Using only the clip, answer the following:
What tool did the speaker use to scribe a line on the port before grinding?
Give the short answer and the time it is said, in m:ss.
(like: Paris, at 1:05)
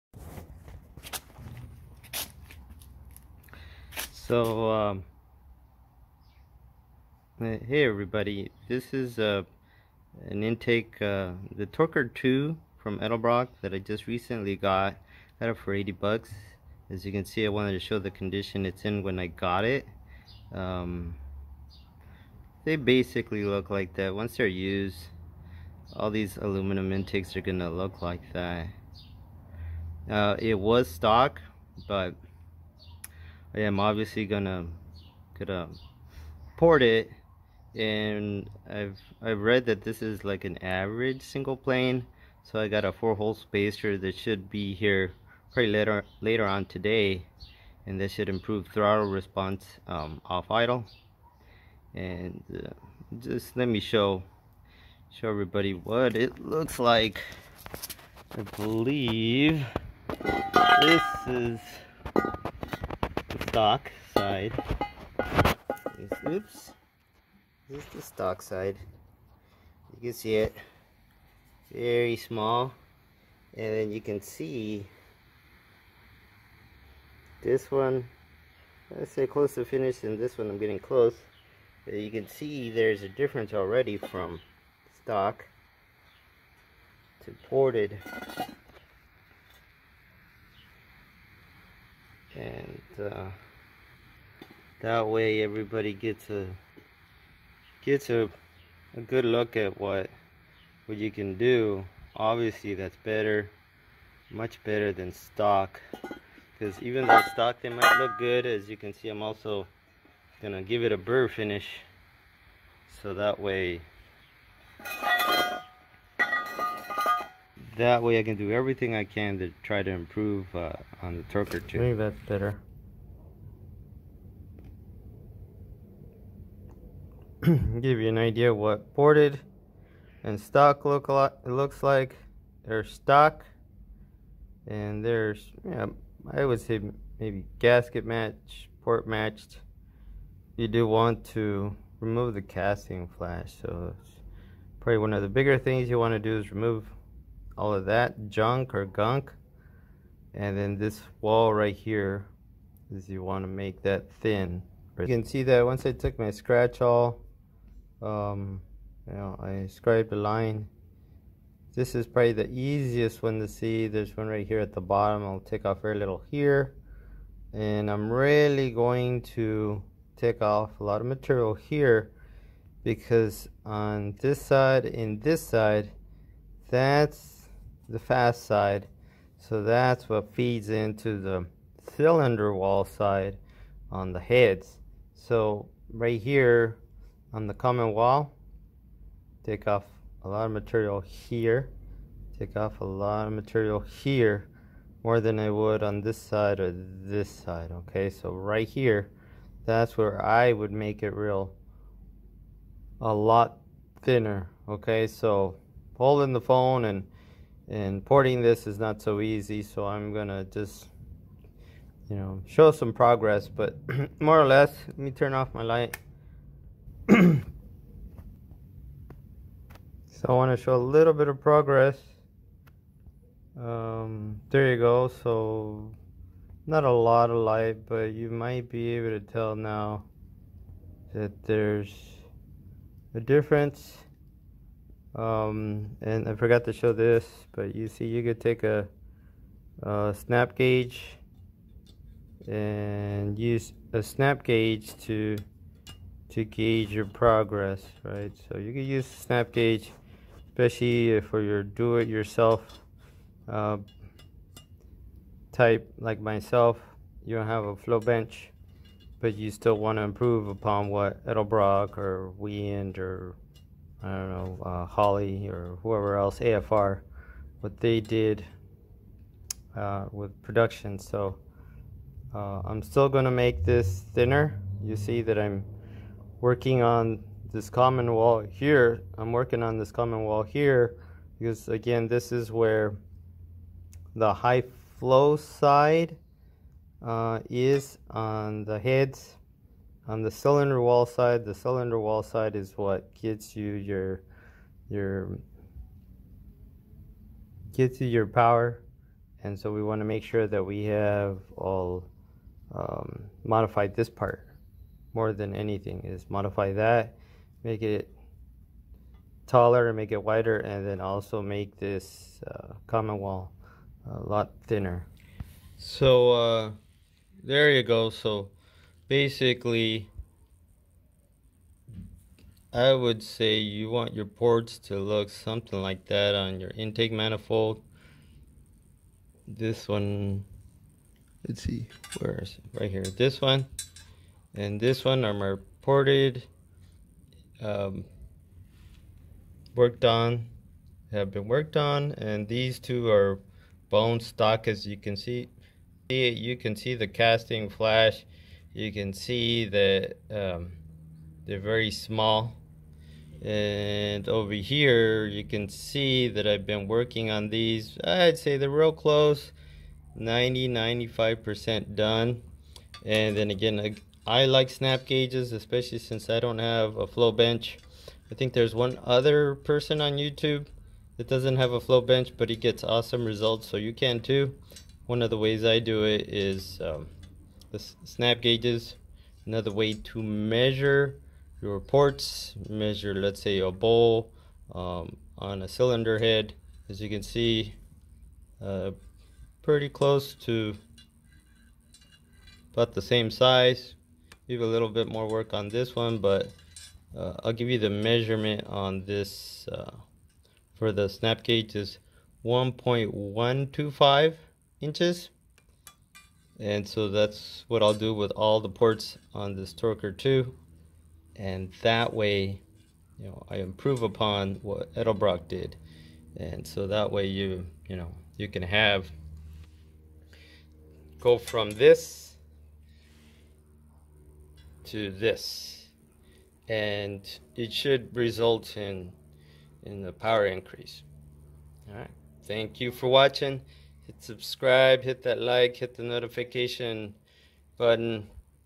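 scratch all, at 2:36.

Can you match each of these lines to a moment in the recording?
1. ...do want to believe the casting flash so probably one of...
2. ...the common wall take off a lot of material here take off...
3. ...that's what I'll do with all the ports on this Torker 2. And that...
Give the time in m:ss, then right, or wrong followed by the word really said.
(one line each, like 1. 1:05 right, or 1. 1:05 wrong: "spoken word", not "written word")
1. 2:20 wrong: "remove", not "believe"
2. 3:07 right
3. 6:47 right.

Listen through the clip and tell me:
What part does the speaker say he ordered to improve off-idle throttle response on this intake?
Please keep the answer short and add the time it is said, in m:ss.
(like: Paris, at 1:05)
four hole spacer, at 0:42.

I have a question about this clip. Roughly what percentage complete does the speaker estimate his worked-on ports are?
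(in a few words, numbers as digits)
90-95%.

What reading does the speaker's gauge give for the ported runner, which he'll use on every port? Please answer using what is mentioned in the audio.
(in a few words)
1.125 inches.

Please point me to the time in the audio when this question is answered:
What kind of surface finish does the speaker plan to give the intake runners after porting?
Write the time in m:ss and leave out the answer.
1:50.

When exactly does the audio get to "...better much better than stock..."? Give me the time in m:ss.
1:43.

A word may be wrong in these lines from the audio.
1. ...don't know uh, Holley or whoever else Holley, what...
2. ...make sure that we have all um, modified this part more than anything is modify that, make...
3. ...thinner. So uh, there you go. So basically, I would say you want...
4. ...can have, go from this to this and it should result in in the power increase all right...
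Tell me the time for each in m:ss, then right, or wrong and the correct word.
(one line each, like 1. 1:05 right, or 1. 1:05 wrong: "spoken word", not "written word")
1. 4:24 wrong: "AFR", not "Holley"
2. 5:00 right
3. 5:14 right
4. 6:58 right.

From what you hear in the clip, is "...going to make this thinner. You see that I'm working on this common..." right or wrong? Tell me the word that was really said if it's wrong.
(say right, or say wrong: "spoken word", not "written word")
right.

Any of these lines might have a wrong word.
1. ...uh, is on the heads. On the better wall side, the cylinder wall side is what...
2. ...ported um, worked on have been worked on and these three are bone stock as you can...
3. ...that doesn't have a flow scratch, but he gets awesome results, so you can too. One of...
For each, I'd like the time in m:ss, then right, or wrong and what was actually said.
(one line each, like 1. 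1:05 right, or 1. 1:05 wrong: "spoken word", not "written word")
1. 4:47 wrong: "cylinder", not "better"
2. 5:35 wrong: "two", not "three"
3. 6:11 wrong: "bench", not "scratch".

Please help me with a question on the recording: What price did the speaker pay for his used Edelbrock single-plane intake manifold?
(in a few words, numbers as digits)
$80.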